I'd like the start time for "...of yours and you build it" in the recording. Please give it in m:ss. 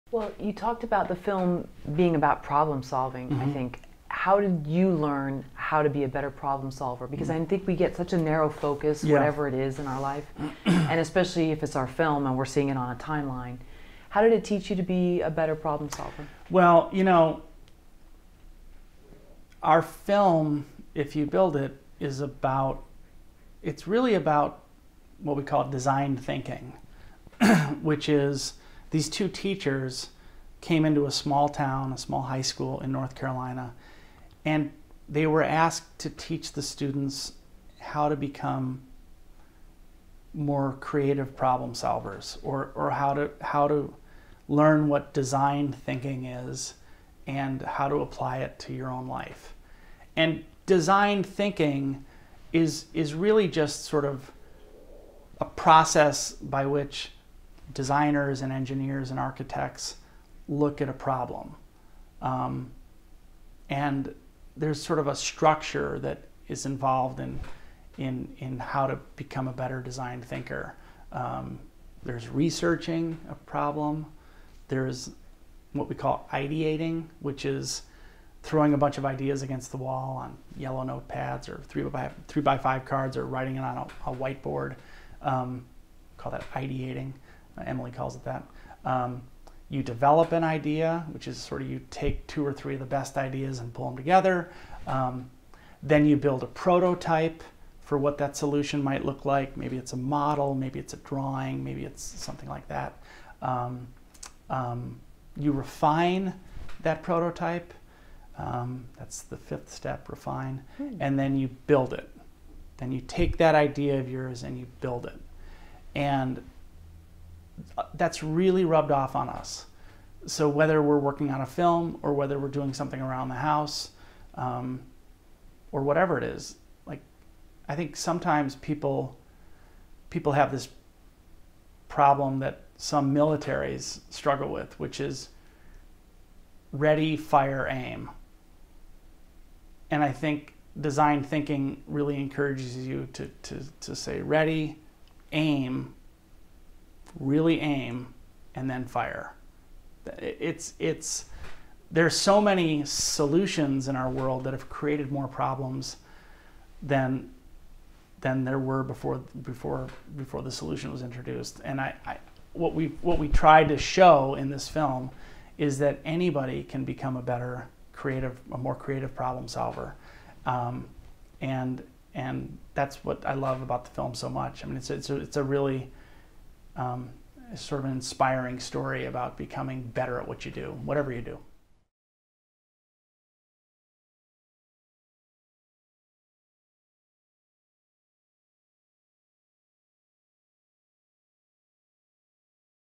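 1:53.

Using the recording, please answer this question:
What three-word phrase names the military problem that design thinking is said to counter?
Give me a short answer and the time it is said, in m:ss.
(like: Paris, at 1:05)
Ready, fire, aim, at 2:16.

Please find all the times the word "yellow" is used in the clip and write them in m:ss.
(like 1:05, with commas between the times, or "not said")
1:20.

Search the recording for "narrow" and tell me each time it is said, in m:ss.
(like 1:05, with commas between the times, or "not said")
0:08.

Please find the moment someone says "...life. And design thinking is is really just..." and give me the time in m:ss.
0:49.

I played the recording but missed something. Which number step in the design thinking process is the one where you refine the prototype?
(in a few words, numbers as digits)
5th.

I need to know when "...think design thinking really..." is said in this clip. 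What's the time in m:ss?
2:20.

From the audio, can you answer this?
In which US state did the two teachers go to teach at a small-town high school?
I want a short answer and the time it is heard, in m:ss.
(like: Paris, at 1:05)
North Carolina, at 0:32.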